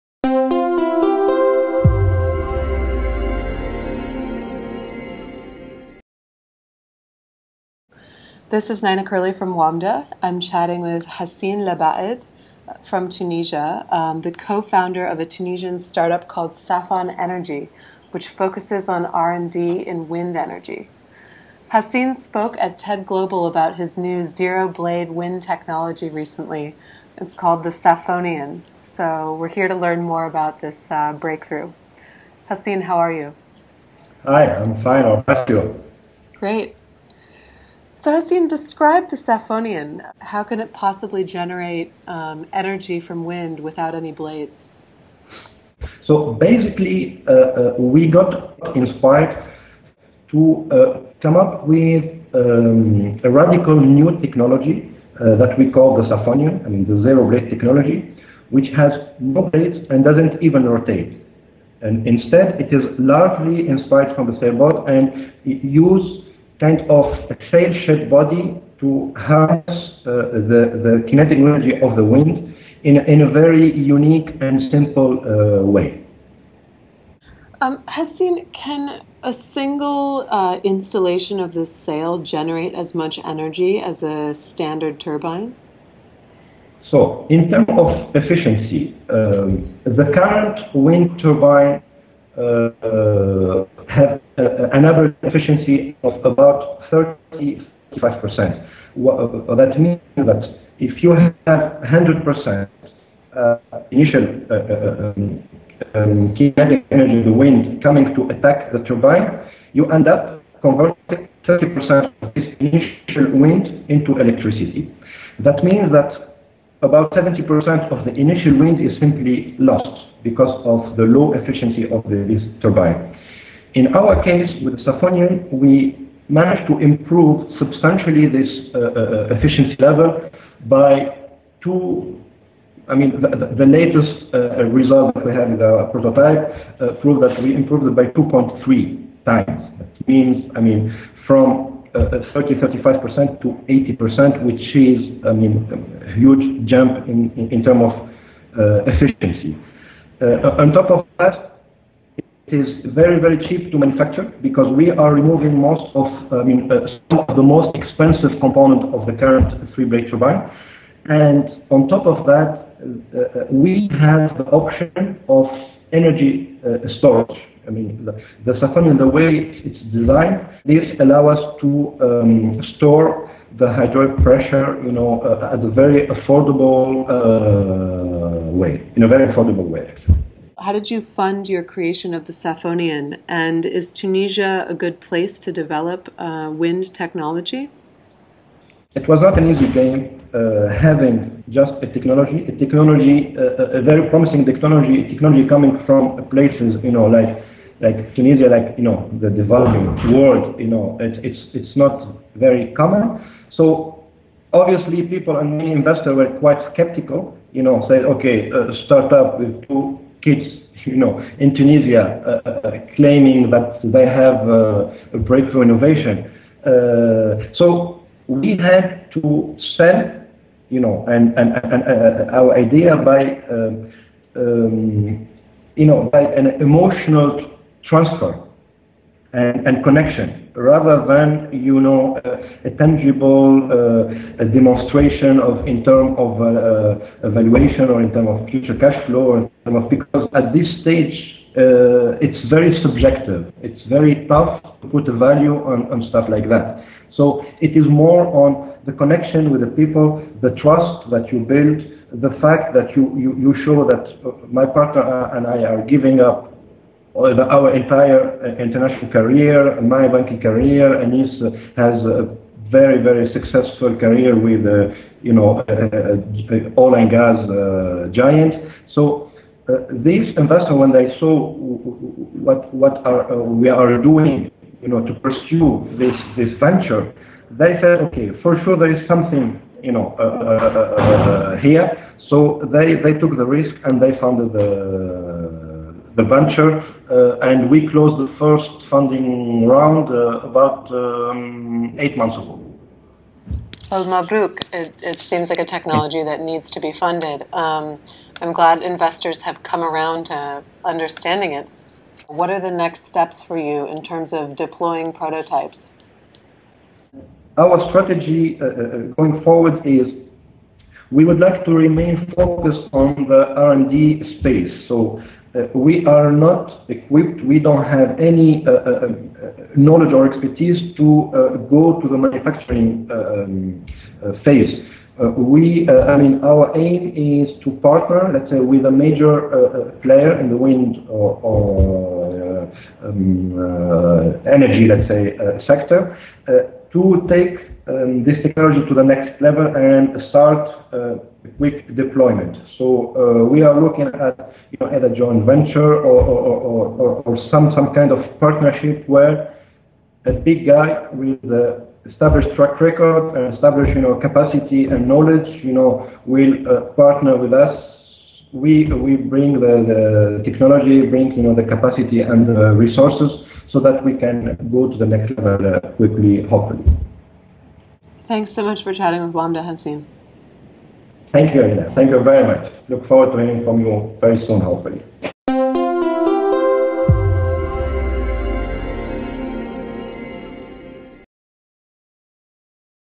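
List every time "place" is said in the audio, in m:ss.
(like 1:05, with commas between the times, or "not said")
3:05, 3:16.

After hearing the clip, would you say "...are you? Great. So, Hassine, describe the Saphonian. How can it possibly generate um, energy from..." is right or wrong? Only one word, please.
right.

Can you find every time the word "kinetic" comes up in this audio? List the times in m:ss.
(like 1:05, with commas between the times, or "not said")
1:11, 1:46.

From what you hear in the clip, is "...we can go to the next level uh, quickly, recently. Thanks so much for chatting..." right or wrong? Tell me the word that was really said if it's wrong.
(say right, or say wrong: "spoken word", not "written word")
wrong: "hopefully", not "recently".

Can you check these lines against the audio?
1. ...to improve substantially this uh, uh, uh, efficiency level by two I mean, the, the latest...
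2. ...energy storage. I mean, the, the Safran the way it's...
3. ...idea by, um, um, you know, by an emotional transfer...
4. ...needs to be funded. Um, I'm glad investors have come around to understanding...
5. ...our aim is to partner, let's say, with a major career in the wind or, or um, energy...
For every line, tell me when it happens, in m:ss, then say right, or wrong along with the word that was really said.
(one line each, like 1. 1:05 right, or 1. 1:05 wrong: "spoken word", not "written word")
1. 2:06 right
2. 2:45 right
3. 3:42 right
4. 4:56 right
5. 5:26 wrong: "player", not "career".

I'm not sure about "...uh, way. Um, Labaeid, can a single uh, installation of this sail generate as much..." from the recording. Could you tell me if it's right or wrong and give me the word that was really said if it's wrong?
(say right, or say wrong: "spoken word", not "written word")
wrong: "Hassine", not "Labaeid".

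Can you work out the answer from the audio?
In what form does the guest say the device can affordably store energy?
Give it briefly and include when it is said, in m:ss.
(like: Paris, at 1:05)
hydraulic pressure, at 2:53.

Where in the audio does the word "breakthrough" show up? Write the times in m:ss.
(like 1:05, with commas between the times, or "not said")
0:31, 3:35.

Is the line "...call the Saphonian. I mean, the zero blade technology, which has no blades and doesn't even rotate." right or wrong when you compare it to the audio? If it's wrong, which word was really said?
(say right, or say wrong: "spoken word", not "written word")
right.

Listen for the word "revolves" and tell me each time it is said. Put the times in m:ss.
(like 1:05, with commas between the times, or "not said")
not said.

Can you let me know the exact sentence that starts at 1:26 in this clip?
So, in terms of efficiency, um, the current wind turbine uh, uh uh, an average efficiency of about 35%.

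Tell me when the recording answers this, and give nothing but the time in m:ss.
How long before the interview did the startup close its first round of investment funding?
4:51.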